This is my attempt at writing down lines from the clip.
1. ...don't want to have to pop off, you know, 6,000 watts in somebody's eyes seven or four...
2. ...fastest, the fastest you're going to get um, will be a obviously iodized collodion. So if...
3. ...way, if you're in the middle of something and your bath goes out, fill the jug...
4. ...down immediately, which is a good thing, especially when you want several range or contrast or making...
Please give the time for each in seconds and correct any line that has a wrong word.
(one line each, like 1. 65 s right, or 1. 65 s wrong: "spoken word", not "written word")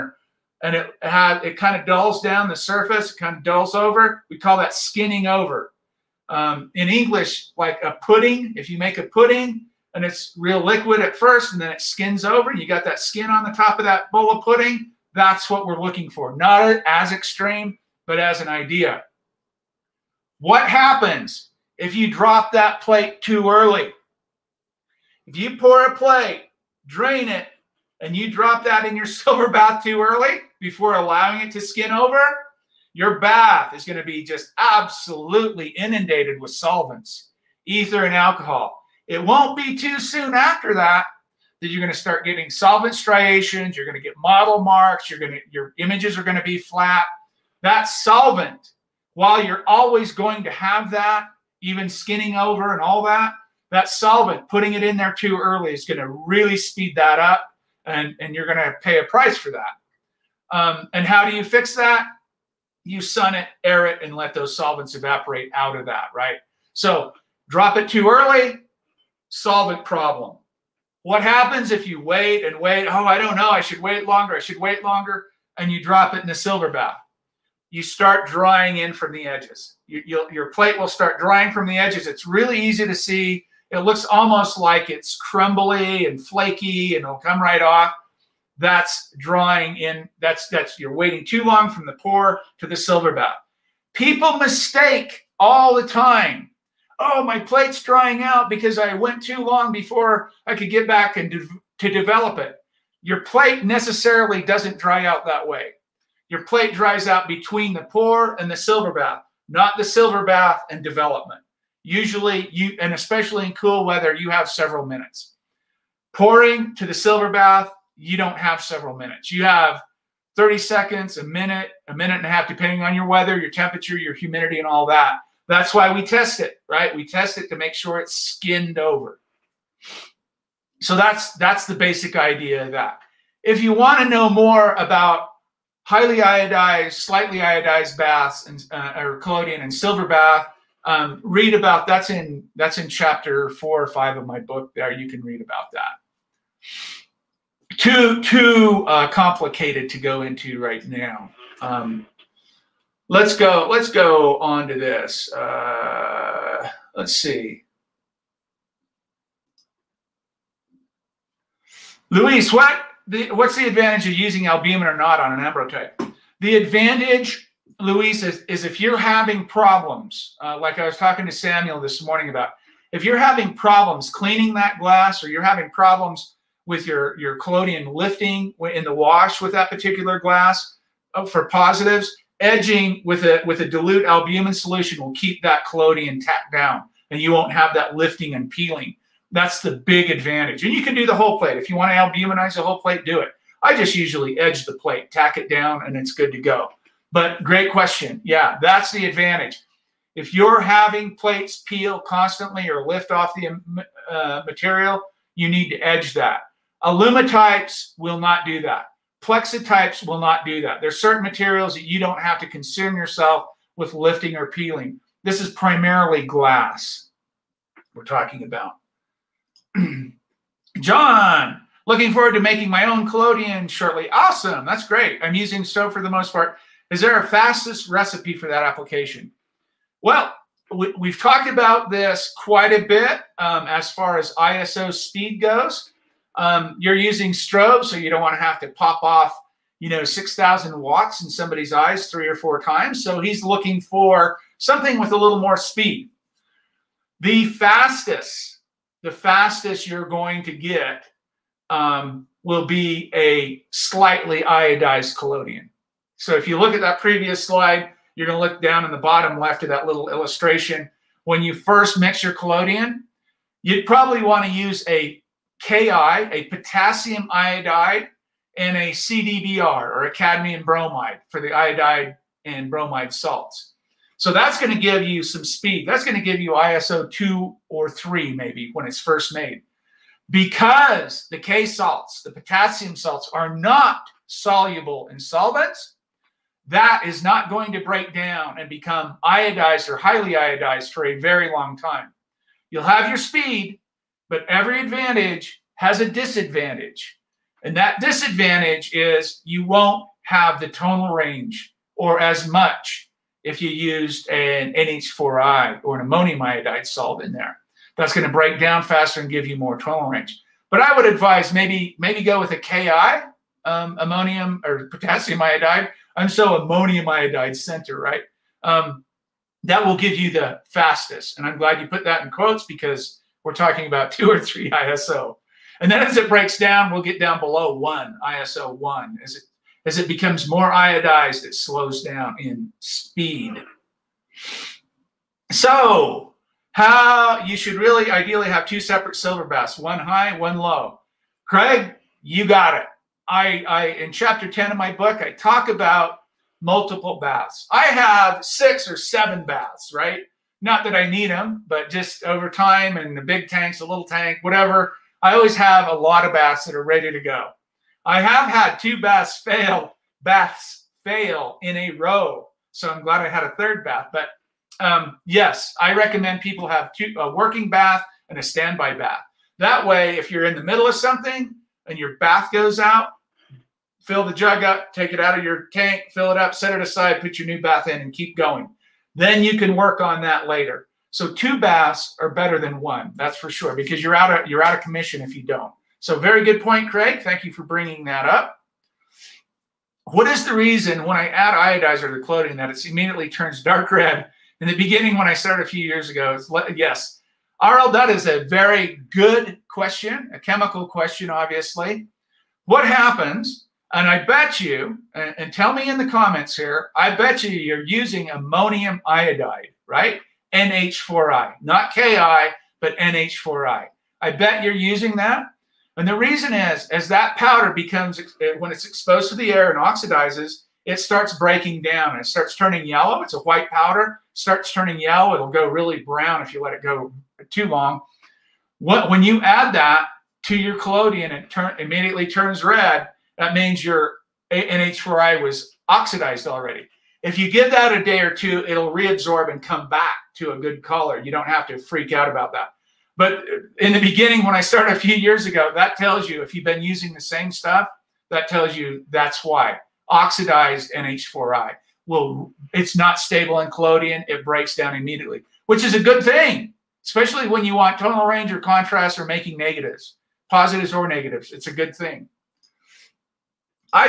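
1. 238 s wrong: "three", not "seven"
2. 247 s wrong: "slightly", not "obviously"
3. 369 s right
4. 454 s wrong: "tonal", not "several".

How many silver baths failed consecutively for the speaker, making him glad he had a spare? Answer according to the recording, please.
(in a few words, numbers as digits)
2.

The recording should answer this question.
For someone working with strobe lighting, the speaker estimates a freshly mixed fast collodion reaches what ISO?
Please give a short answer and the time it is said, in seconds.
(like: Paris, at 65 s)
2 or 3, at 276 s.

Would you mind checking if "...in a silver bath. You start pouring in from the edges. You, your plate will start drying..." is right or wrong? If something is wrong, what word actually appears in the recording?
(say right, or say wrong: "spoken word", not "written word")
wrong: "drying", not "pouring".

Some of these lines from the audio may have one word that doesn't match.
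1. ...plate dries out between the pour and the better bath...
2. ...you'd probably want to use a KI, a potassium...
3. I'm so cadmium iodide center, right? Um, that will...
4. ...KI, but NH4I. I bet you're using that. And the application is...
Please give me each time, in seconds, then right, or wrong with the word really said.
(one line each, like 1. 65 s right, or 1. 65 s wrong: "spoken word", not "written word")
1. 106 s wrong: "silver", not "better"
2. 263 s right
3. 316 s wrong: "ammonium", not "cadmium"
4. 411 s wrong: "reason", not "application".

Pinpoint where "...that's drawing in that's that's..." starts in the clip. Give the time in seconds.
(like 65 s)
88 s.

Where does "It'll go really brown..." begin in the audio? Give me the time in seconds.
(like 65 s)
425 s.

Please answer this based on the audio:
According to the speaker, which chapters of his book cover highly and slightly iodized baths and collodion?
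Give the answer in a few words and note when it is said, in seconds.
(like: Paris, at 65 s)
Chapter 4 or 5, at 142 s.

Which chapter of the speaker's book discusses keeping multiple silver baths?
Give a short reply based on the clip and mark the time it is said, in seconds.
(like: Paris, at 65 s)
Chapter 10, at 344 s.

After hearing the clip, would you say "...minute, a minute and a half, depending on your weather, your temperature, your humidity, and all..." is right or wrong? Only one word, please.
right.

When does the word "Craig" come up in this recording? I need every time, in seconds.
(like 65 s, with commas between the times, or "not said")
341 s, 386 s.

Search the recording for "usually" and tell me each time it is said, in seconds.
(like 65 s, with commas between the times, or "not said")
111 s, 193 s.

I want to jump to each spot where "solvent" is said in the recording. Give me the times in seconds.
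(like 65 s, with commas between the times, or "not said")
36 s, 42 s, 47 s, 53 s, 64 s, 69 s, 285 s.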